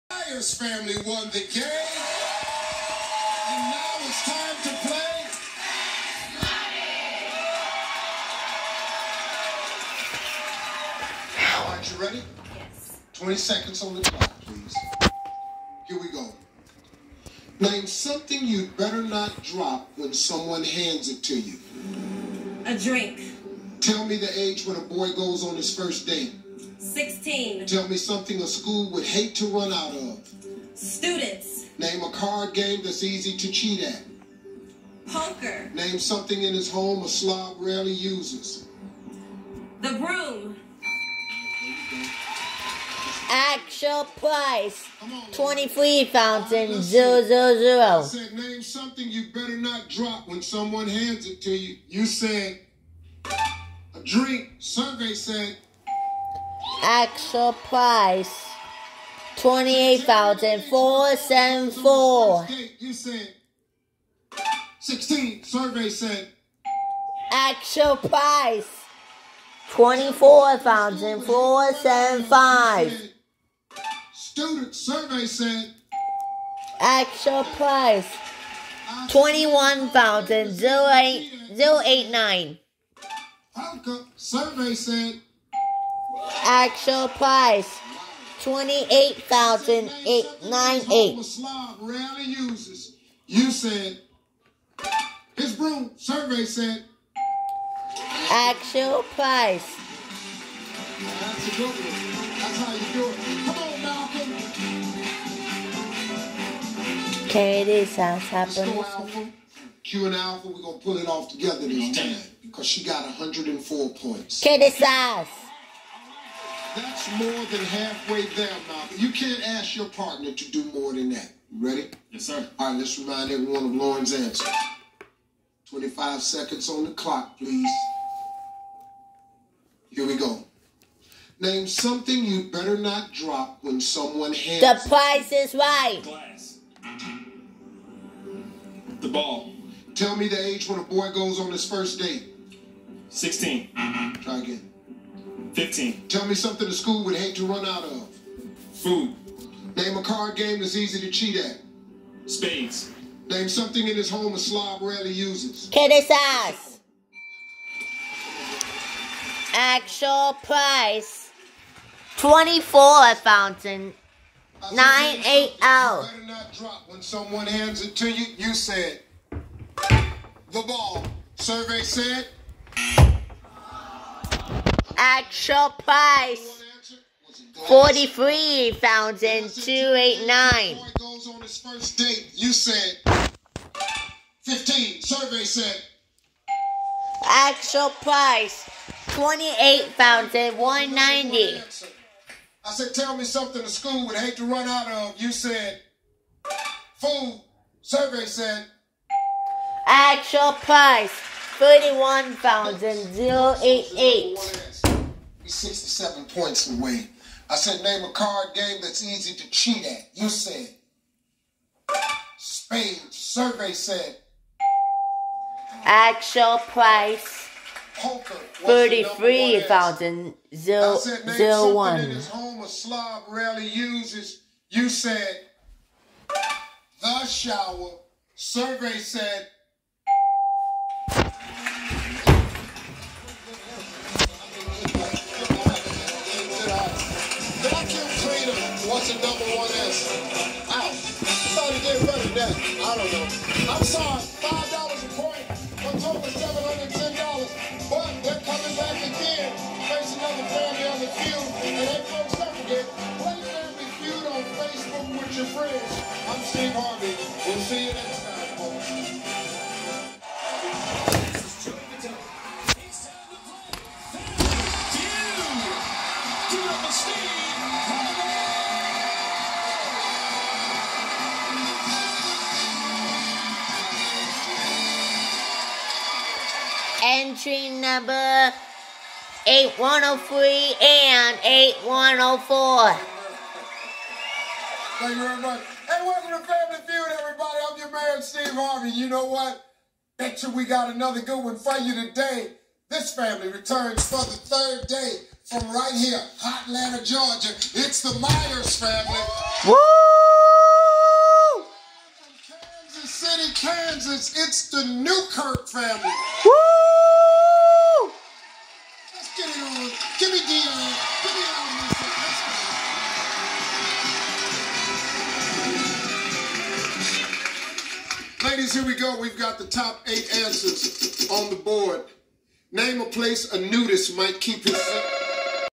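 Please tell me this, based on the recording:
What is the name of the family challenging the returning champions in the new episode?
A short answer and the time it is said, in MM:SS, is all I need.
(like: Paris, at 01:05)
Newkirk, at 05:04.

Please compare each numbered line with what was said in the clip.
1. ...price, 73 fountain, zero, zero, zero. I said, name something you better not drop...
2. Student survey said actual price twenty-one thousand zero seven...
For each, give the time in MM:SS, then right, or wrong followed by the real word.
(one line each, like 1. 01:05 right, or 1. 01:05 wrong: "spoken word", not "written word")
1. 00:44 wrong: "23", not "73"
2. 01:14 wrong: "eight", not "seven".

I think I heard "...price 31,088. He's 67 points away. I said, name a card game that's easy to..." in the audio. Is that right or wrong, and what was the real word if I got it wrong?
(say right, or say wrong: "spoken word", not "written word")
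right.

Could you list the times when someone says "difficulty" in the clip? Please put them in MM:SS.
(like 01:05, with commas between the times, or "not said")
not said.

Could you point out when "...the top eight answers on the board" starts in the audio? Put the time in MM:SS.
05:19.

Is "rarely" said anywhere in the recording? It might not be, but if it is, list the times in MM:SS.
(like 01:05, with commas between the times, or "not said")
00:37, 01:31, 02:34, 03:43.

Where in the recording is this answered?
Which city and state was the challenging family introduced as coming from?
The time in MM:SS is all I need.
05:02.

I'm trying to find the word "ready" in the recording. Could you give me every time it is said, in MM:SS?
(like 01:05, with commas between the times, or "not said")
00:12, 02:01.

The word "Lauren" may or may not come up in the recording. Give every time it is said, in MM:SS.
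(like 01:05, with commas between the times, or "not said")
02:03.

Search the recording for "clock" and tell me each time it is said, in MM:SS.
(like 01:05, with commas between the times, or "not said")
00:14, 02:06.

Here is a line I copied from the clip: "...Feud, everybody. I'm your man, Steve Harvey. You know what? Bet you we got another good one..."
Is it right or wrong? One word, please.
right.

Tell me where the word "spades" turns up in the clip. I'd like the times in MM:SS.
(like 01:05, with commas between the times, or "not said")
02:32, 03:32.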